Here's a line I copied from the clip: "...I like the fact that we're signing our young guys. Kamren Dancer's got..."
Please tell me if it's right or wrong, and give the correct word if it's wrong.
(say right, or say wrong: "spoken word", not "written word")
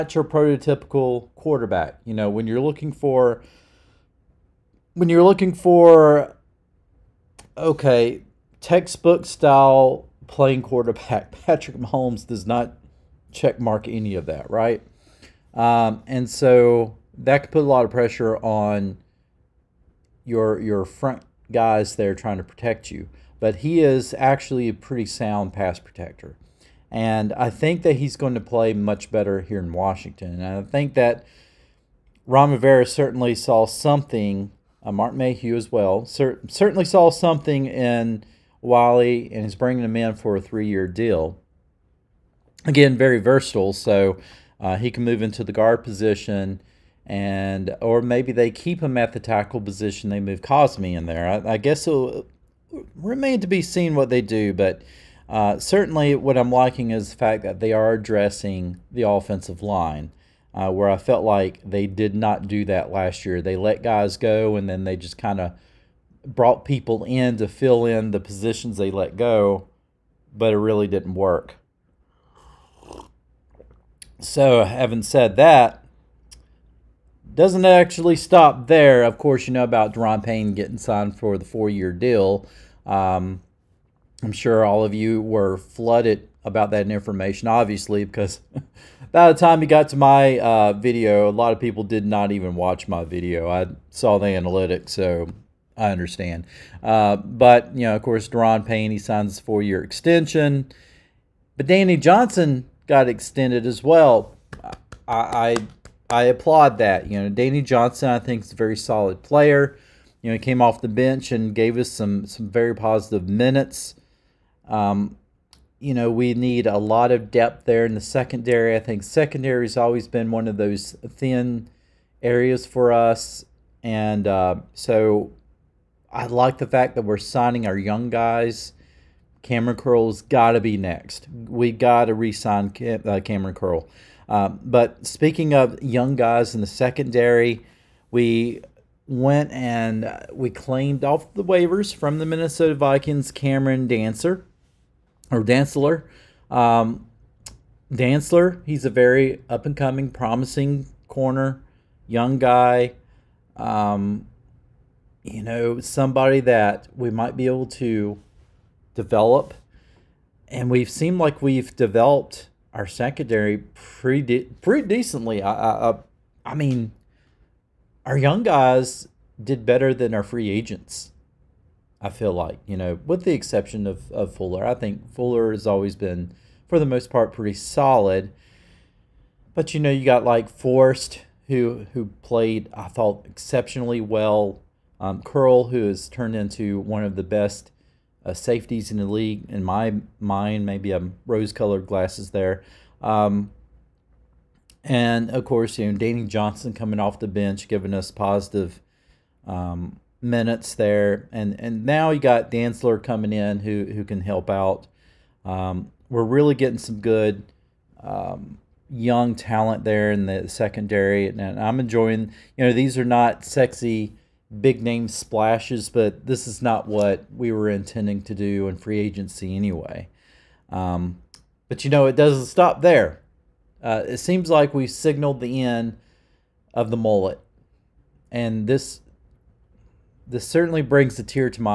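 wrong: "Curl", not "Dancer".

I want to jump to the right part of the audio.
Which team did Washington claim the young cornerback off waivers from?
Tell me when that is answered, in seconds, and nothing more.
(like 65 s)
142 s.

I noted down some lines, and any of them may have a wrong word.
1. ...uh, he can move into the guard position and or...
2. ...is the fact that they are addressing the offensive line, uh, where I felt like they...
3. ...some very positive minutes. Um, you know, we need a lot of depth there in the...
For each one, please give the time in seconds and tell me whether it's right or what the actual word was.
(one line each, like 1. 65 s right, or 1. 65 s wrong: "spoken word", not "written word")
1. 44 s right
2. 56 s right
3. 112 s right.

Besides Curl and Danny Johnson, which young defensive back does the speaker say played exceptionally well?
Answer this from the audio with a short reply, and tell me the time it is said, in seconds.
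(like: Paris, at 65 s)
Forrest, at 180 s.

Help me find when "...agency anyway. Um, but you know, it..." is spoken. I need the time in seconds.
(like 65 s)
218 s.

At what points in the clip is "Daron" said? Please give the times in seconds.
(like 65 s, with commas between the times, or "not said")
79 s, 98 s.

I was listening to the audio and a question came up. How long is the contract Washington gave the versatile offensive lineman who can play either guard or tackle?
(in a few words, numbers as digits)
3 years.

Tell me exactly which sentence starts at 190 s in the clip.
Maybe I'm rose colored glasses there.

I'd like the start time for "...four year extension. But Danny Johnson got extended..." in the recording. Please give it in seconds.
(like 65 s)
99 s.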